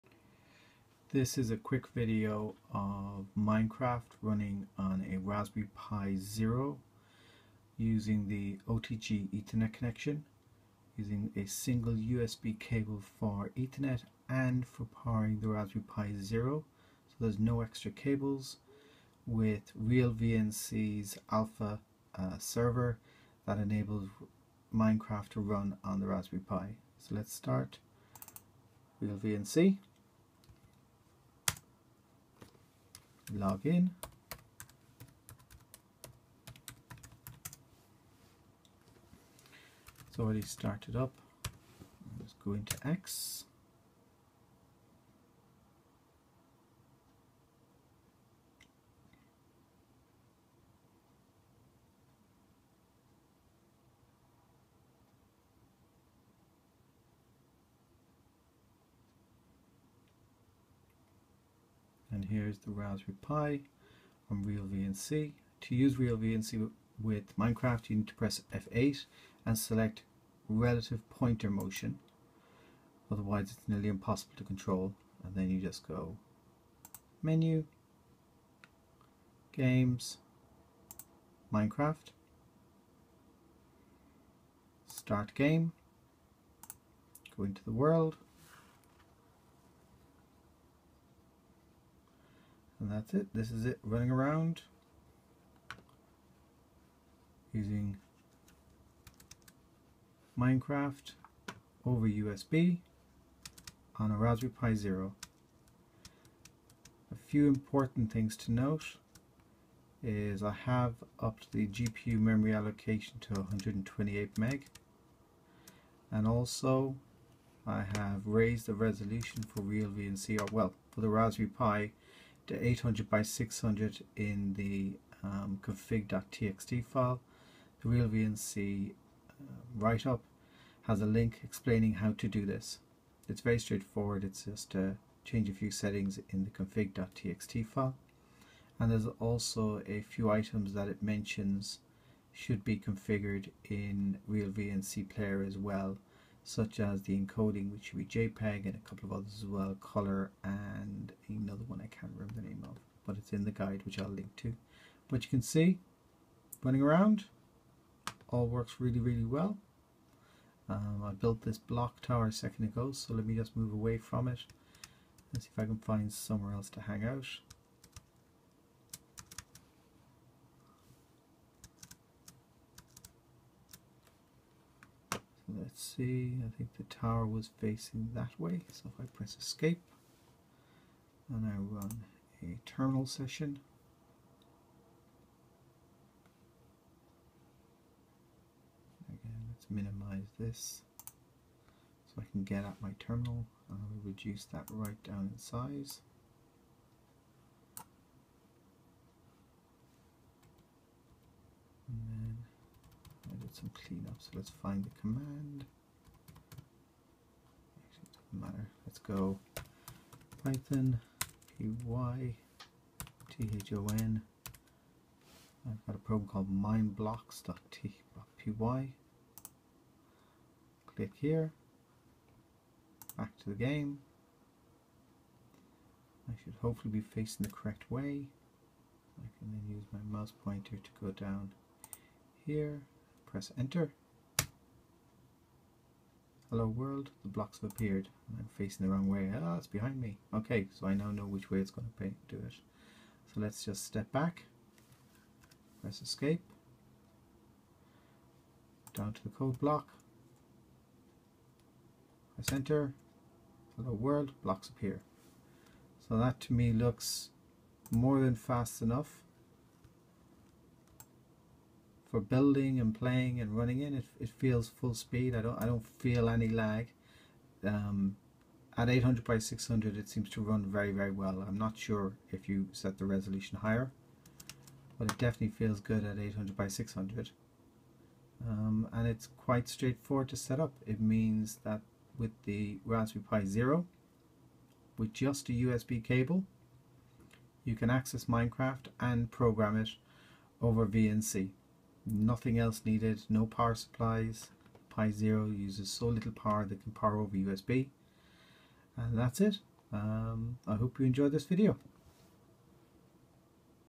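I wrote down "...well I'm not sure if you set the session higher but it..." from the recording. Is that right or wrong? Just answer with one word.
wrong.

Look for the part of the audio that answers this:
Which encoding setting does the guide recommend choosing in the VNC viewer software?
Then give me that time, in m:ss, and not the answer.
2:28.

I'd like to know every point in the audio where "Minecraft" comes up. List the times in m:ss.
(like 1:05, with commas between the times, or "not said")
0:03, 0:24, 1:07, 1:21, 1:40, 4:48.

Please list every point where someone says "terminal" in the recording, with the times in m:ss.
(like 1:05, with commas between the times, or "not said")
3:02, 3:12.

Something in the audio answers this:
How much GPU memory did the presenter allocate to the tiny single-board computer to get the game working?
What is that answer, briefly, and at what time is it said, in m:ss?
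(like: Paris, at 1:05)
128 MB, at 1:53.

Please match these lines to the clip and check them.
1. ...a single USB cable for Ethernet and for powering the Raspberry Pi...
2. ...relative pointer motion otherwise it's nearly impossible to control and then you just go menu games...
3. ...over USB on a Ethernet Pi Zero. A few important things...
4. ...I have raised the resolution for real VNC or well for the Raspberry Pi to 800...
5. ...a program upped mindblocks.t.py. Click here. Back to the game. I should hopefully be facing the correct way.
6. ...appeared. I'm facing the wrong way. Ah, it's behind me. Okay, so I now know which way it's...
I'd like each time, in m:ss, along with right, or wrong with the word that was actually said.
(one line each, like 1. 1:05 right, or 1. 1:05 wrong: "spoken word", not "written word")
1. 0:11 right
2. 1:10 right
3. 1:41 wrong: "Raspberry", not "Ethernet"
4. 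1:57 right
5. 3:35 wrong: "called", not "upped"
6. 3:57 right.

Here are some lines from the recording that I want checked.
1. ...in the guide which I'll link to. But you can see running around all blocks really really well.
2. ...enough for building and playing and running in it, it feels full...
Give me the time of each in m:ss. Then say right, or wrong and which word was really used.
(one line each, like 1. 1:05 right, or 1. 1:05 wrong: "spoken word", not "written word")
1. 2:33 wrong: "works", not "blocks"
2. 4:18 right.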